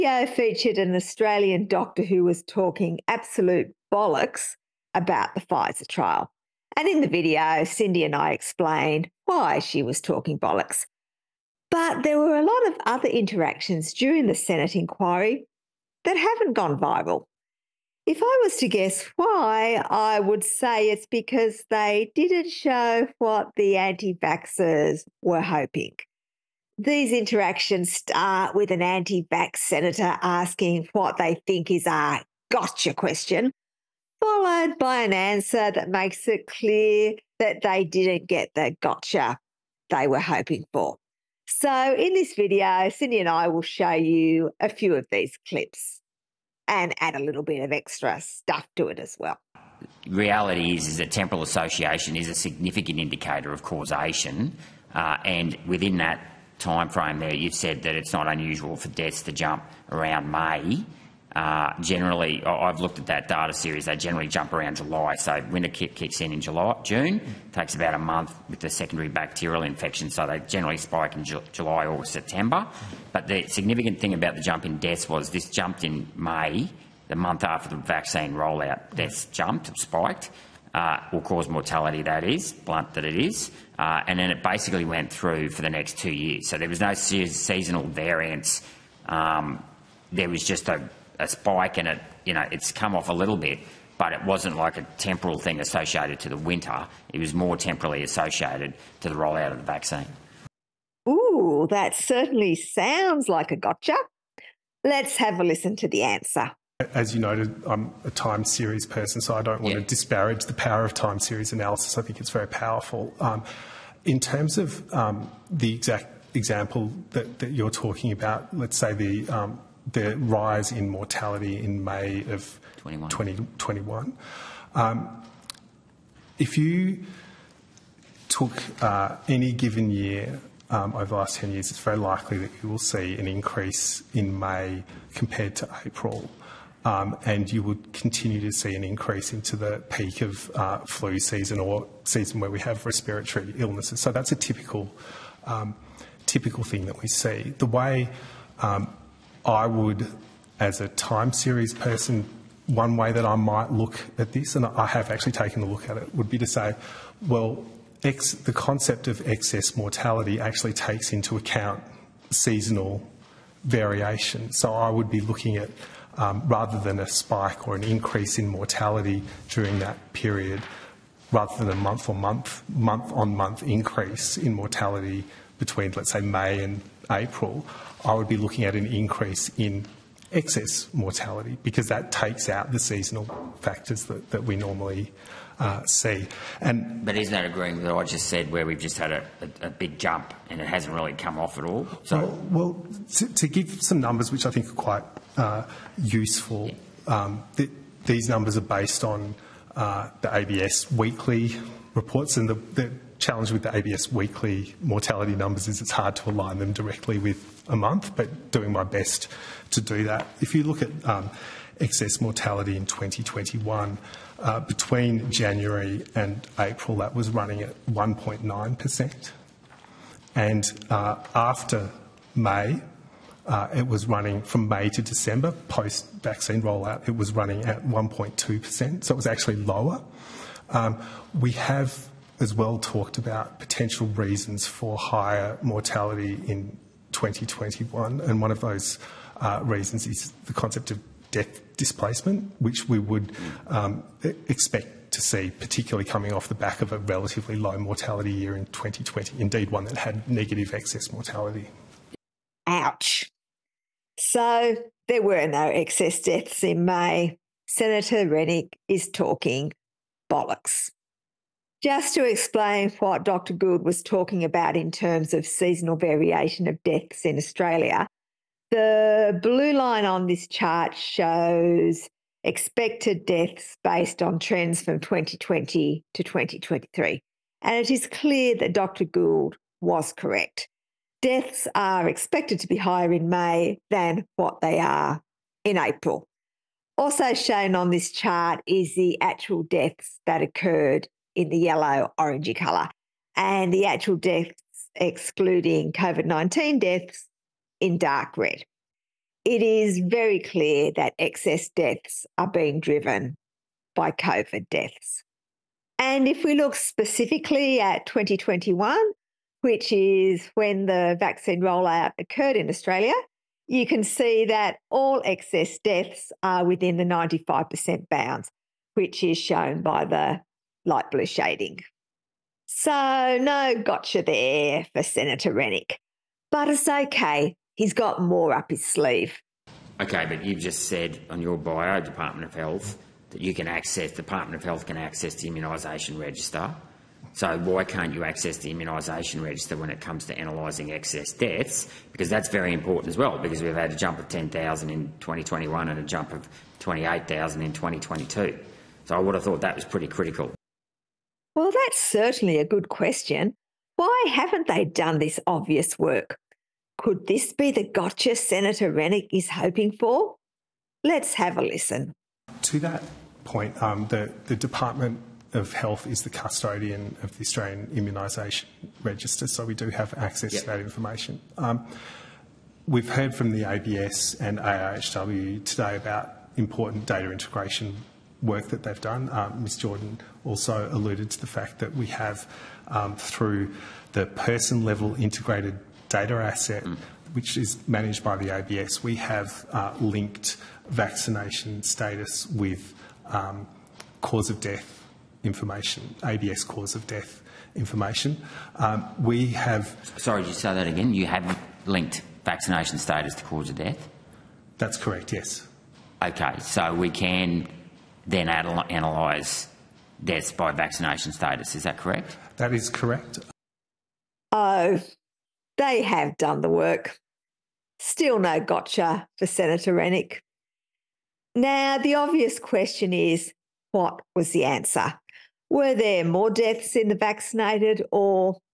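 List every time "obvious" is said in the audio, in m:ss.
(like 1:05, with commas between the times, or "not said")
5:55, 7:02.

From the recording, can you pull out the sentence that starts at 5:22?
So, no gotcha there for Senator Rennick.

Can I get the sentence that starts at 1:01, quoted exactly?
Uh, generally, I've looked at that data series, they generally jump around July.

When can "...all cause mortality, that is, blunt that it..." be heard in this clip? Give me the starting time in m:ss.
1:21.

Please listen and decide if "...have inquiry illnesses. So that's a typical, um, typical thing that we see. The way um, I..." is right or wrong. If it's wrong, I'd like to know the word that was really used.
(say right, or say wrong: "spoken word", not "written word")
wrong: "respiratory", not "inquiry".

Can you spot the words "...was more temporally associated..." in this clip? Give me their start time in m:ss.
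1:37.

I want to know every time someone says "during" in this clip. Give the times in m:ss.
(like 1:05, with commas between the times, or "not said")
0:13, 2:49.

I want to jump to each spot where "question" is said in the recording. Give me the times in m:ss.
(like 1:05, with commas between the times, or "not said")
0:32, 5:52, 7:02.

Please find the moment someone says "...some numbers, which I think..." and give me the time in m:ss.
3:13.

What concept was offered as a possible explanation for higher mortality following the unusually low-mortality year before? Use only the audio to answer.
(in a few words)
death displacement.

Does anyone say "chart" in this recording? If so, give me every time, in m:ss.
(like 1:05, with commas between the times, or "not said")
4:30, 4:48.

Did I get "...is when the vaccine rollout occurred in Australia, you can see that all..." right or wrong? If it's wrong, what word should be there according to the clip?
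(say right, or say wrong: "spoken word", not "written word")
right.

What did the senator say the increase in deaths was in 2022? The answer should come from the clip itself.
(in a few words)
28,000.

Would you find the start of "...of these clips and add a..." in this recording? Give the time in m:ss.
0:44.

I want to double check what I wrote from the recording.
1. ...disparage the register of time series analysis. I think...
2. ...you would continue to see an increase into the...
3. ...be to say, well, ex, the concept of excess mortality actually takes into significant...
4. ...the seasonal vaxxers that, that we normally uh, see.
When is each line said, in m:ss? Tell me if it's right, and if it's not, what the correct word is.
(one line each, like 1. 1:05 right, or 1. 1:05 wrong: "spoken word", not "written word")
1. 1:49 wrong: "power", not "register"
2. 2:17 right
3. 2:36 wrong: "account", not "significant"
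4. 3:02 wrong: "factors", not "vaxxers".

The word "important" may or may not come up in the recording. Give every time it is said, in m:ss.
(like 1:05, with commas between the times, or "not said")
5:42, 6:16.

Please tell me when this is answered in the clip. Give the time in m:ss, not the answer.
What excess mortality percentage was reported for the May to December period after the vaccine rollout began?
3:47.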